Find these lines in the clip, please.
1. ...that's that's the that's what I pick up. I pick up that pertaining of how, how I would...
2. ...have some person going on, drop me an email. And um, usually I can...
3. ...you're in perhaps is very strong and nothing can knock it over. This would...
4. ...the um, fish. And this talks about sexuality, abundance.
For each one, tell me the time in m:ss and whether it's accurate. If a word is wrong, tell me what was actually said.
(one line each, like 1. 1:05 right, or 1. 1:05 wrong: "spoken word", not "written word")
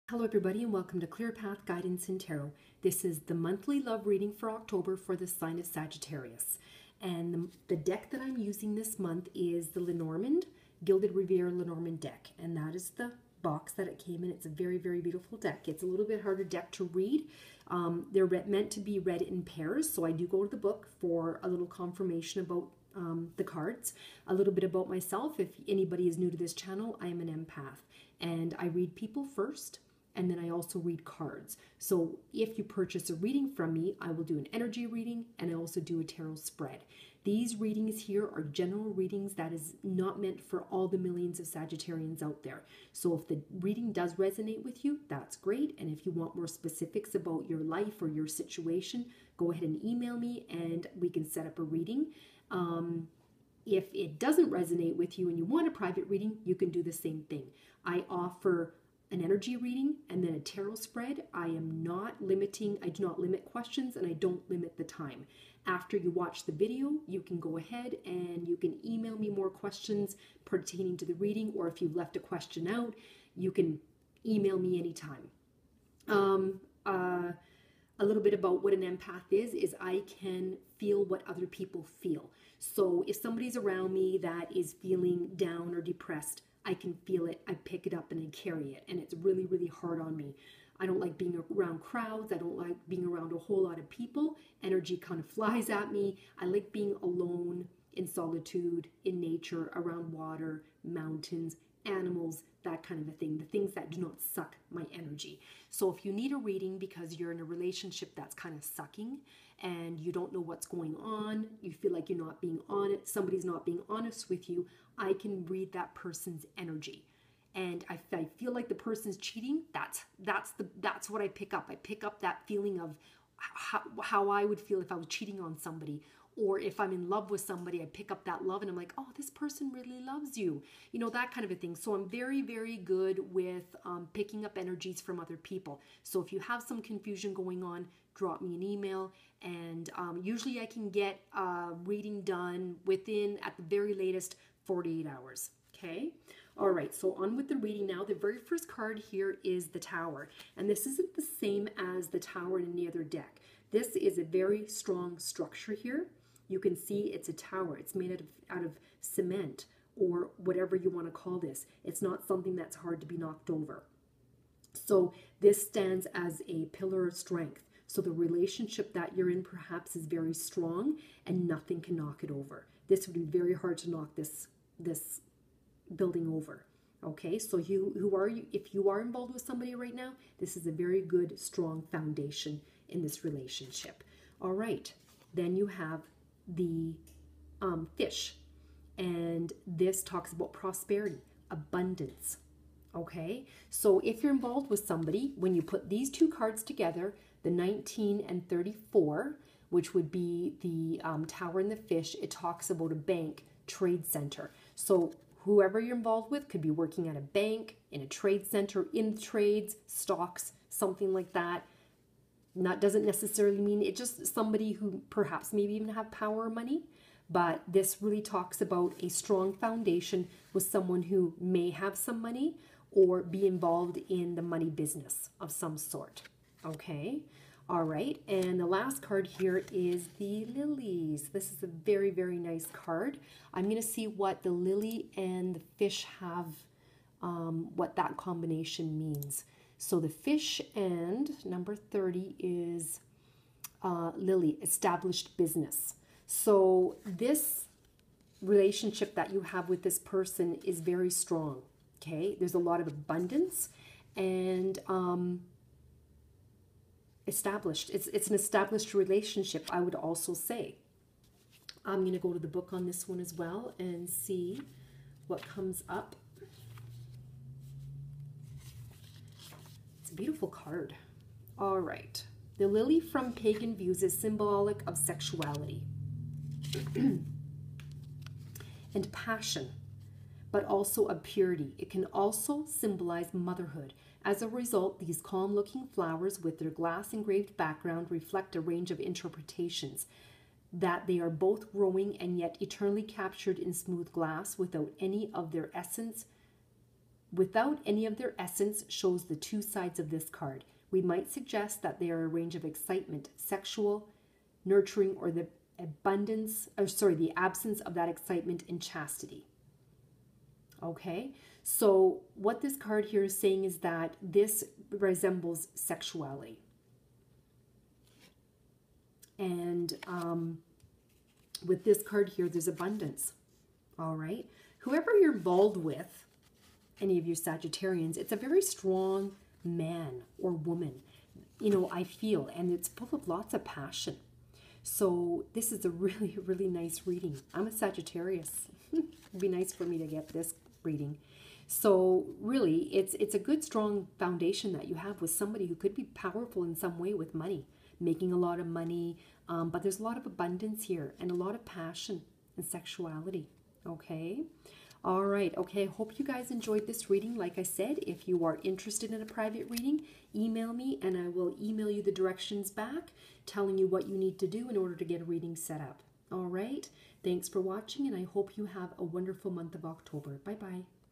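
1. 1:59 wrong: "feeling", not "pertaining"
2. 2:16 wrong: "confusion", not "person"
3. 2:49 right
4. 3:06 wrong: "prosperity", not "sexuality".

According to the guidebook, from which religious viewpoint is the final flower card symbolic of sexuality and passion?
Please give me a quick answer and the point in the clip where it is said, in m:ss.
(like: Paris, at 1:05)
pagan, at 4:33.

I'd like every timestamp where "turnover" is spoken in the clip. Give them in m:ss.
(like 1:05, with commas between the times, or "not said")
not said.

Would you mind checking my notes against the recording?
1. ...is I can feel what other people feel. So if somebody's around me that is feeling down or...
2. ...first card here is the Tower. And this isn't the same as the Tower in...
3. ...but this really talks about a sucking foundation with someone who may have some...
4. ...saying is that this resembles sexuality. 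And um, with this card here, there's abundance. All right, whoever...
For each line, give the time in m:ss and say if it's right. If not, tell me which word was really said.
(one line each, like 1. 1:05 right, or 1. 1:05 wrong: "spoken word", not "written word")
1. 1:19 right
2. 2:28 right
3. 3:37 wrong: "strong", not "sucking"
4. 5:13 right.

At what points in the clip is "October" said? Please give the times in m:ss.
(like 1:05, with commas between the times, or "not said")
0:04, 6:09.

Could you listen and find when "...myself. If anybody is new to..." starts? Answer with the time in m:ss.
0:24.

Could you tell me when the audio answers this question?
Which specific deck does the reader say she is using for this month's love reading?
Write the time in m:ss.
0:10.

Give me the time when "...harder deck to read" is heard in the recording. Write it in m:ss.
0:16.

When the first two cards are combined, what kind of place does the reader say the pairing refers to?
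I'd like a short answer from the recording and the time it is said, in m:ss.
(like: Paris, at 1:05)
bank trade center, at 3:22.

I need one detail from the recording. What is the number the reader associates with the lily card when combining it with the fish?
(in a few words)
30.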